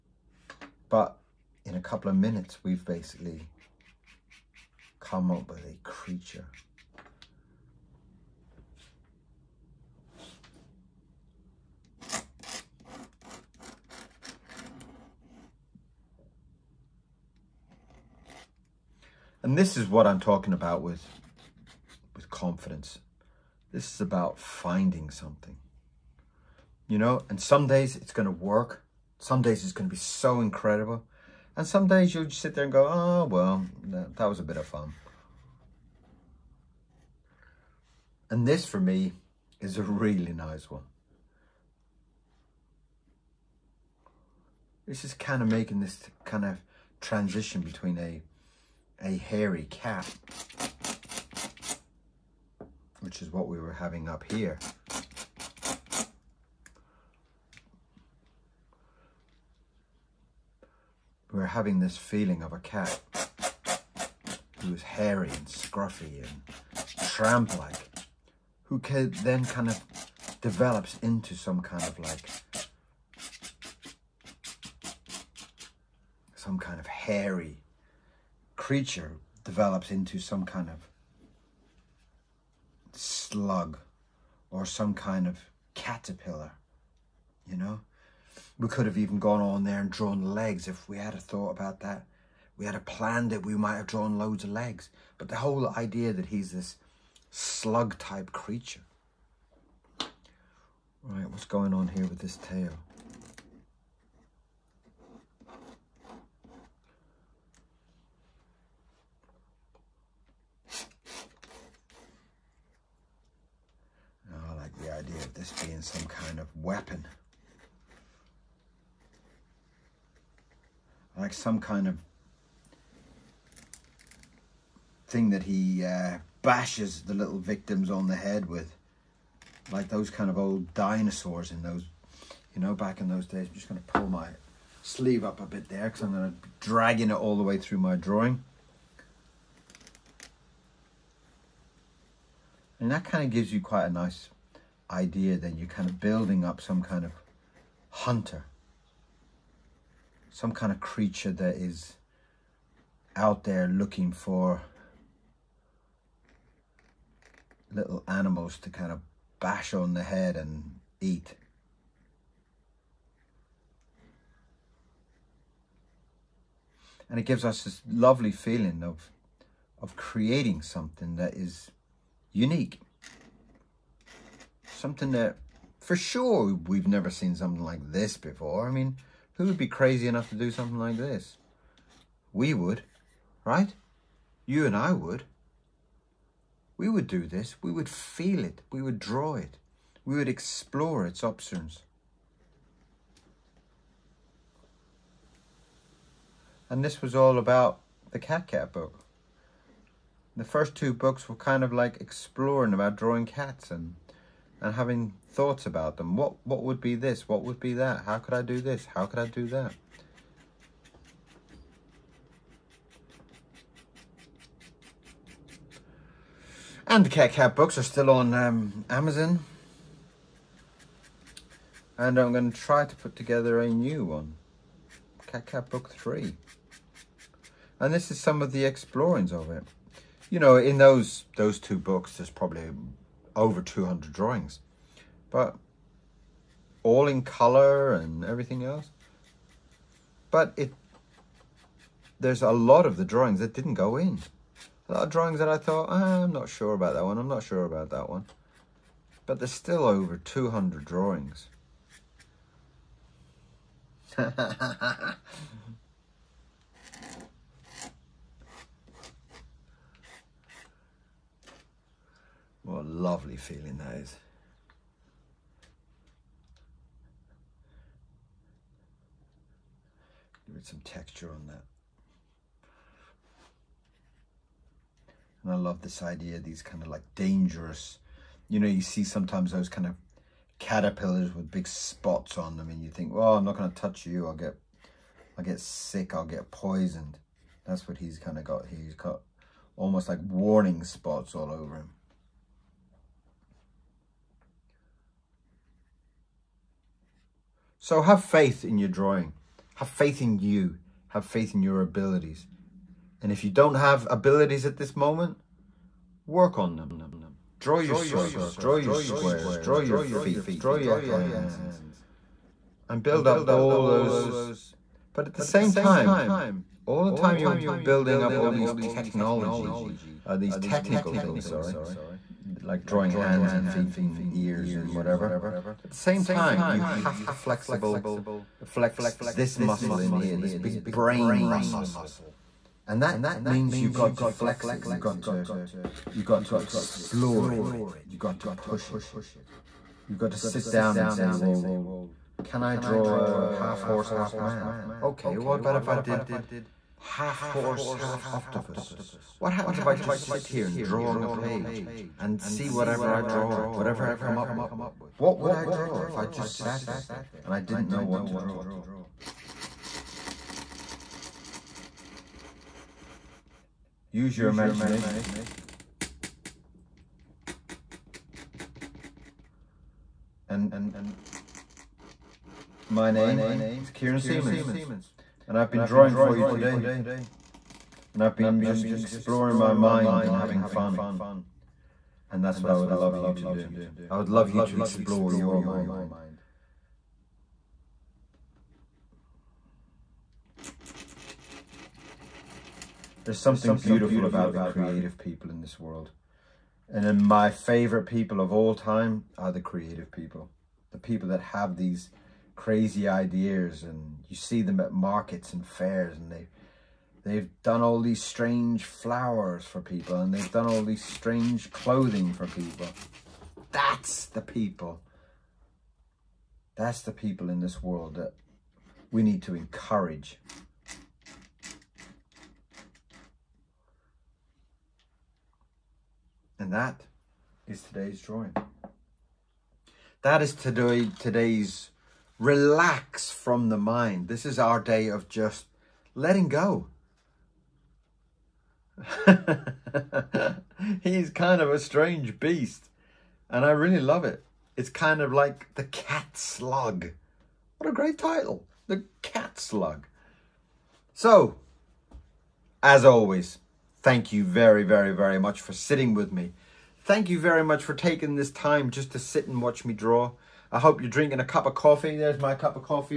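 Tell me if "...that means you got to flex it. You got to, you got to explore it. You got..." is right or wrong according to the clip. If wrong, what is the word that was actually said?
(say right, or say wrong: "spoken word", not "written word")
right.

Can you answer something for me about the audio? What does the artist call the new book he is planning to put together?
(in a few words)
Cat Cat Book 3.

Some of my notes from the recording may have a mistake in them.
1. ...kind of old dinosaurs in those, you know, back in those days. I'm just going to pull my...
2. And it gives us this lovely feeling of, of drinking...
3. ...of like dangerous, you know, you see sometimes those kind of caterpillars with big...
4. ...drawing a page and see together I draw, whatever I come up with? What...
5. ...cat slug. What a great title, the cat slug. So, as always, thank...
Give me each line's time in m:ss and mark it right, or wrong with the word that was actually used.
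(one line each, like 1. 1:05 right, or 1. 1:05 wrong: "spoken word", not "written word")
1. 2:10 right
2. 2:47 wrong: "creating", not "drinking"
3. 4:36 right
4. 5:50 wrong: "whatever", not "together"
5. 7:25 right.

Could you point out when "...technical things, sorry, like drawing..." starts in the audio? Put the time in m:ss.
5:20.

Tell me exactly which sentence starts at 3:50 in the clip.
You know, in those those two books, there's probably over 200 drawings.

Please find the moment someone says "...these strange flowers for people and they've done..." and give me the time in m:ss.
6:48.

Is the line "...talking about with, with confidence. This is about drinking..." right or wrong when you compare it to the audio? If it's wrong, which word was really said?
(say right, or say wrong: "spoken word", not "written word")
wrong: "finding", not "drinking".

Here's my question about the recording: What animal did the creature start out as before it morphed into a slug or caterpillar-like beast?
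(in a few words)
A hairy cat.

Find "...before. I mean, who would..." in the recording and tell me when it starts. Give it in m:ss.
2:58.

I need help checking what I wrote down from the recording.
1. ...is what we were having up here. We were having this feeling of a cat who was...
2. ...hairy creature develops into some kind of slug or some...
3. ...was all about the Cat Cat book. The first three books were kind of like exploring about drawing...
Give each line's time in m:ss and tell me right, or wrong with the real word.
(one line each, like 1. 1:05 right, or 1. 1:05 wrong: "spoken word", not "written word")
1. 0:53 right
2. 1:16 right
3. 3:17 wrong: "two", not "three".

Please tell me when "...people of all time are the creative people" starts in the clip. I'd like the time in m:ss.
6:38.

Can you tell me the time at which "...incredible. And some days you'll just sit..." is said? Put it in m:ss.
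0:30.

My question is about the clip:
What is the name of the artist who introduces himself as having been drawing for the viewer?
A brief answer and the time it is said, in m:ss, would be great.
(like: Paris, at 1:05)
Kieron Seamons, at 6:13.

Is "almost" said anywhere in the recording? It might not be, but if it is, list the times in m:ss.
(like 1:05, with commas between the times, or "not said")
4:49.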